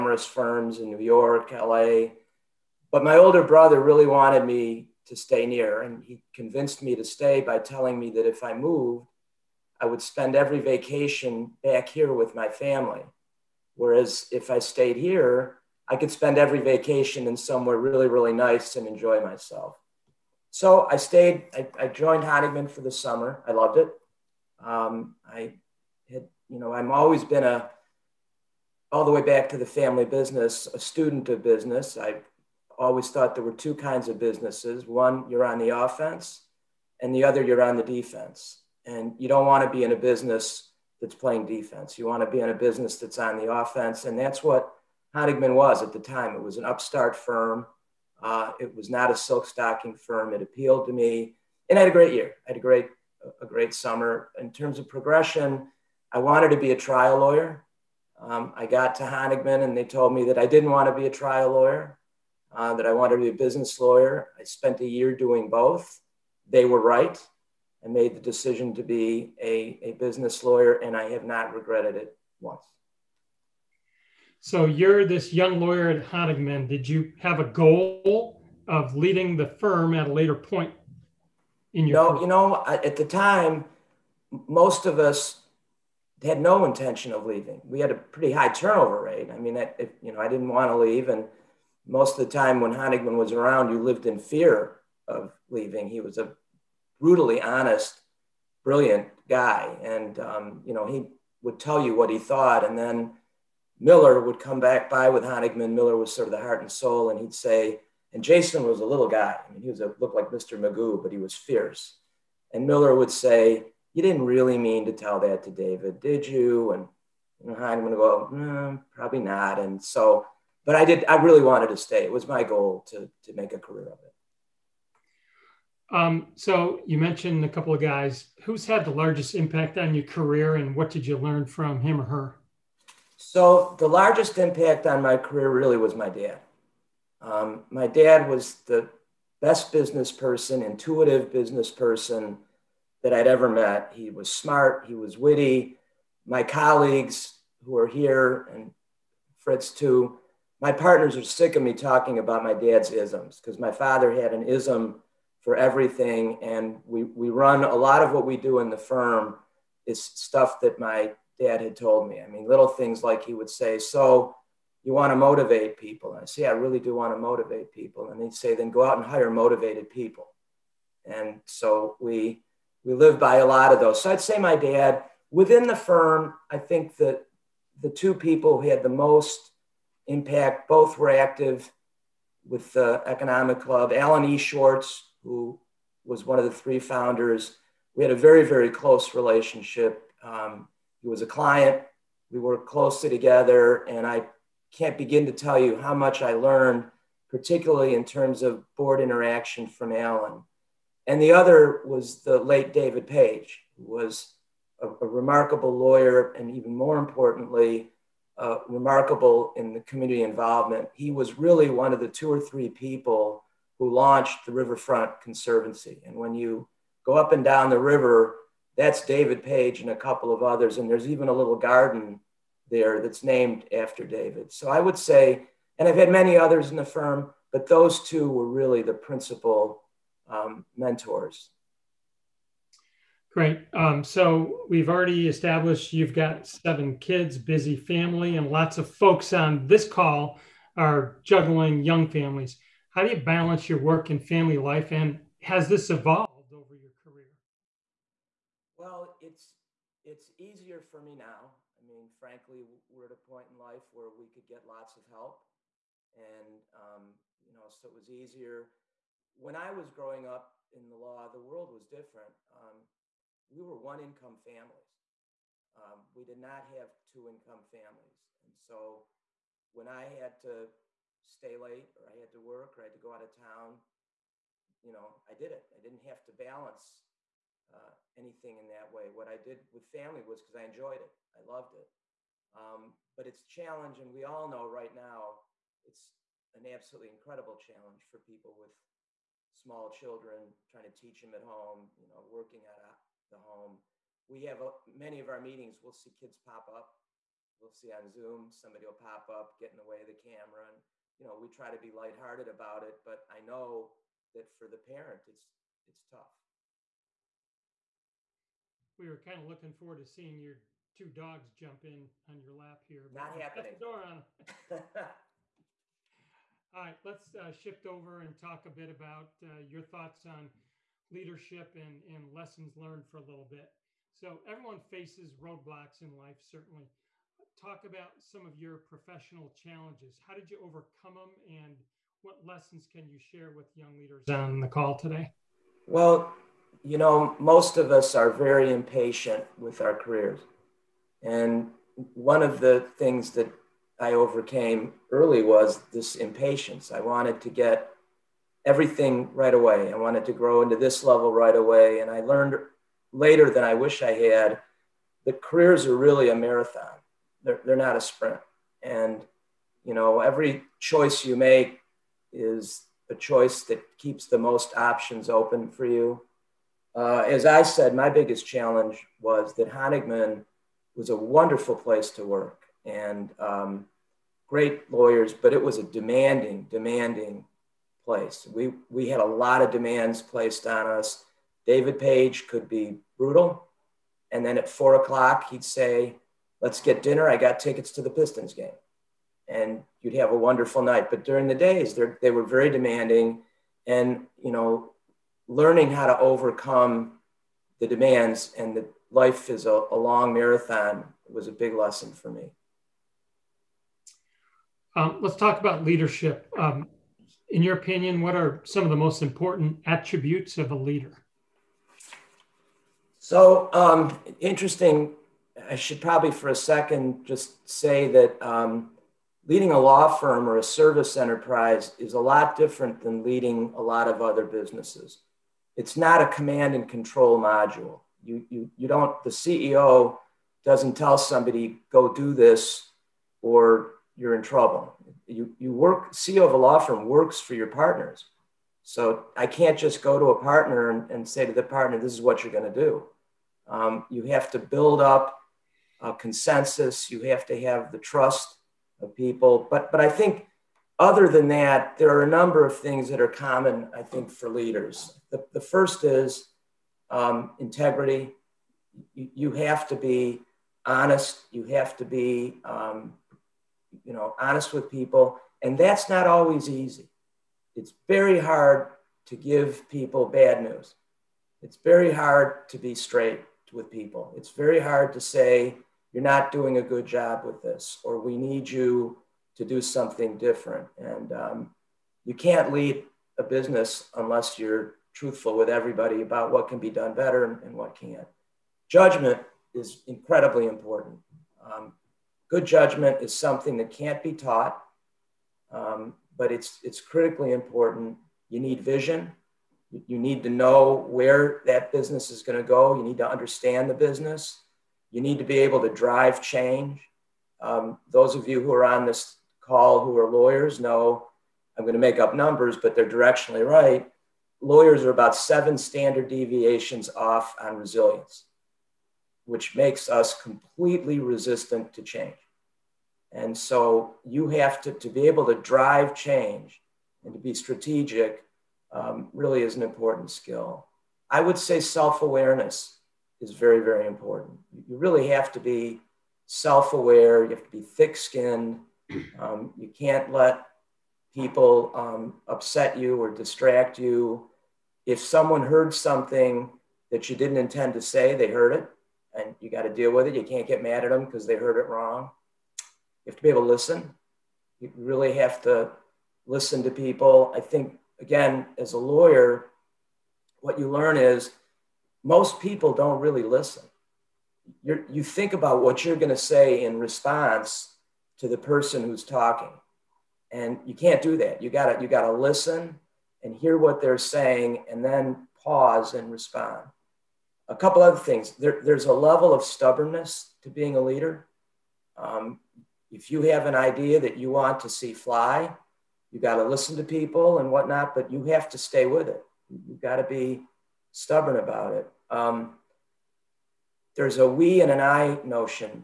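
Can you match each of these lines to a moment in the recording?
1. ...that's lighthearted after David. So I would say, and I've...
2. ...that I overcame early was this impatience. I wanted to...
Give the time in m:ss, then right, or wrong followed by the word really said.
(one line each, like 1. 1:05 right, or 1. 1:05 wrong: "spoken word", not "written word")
1. 3:43 wrong: "named", not "lighthearted"
2. 5:43 right.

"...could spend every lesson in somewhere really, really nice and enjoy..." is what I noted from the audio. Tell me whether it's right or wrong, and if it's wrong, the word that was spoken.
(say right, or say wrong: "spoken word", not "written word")
wrong: "vacation", not "lesson".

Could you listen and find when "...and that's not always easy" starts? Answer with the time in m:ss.
7:45.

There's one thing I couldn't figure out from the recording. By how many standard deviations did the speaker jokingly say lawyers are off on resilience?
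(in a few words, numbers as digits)
7.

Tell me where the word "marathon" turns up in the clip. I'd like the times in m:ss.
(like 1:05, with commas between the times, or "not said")
5:56, 6:40.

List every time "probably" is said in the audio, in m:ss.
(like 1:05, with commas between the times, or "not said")
1:58, 6:55.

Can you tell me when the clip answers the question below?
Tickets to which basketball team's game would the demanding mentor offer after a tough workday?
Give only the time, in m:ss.
6:28.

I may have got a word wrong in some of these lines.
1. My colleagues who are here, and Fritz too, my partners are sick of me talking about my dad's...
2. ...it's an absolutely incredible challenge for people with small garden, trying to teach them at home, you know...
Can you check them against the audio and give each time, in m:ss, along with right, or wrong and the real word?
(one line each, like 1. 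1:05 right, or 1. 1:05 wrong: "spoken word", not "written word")
1. 2:26 right
2. 4:45 wrong: "children", not "garden".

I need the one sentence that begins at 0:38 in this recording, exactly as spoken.
And you don't want to be in a business that's playing defense.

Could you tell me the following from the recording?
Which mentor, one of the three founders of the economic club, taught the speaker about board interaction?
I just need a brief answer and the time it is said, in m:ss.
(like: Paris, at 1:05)
Alan E. Schwartz, at 3:03.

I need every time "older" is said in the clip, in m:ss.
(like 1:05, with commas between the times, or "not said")
0:03.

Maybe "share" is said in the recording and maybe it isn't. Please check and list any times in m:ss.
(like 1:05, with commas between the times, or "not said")
5:33.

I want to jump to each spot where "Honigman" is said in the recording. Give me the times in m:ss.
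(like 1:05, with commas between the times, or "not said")
0:22, 0:45, 0:59, 1:16, 1:32, 1:45, 6:09.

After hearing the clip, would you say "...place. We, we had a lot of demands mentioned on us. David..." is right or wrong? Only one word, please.
wrong.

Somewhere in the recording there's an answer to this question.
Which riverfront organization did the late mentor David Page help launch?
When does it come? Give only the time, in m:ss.
3:34.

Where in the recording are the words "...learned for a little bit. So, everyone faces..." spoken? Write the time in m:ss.
5:22.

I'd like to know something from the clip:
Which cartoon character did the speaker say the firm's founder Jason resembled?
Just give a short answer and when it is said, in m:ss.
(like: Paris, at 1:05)
Mr. Magoo, at 1:50.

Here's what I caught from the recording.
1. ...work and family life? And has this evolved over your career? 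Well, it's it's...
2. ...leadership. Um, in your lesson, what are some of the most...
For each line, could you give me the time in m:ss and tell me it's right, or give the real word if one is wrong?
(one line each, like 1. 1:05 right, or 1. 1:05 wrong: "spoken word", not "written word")
1. 4:03 right
2. 6:45 wrong: "opinion", not "lesson".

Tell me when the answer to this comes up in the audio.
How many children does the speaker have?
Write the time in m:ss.
3:56.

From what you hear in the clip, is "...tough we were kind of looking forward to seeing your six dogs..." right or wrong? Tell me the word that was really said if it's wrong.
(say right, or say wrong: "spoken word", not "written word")
wrong: "two", not "six".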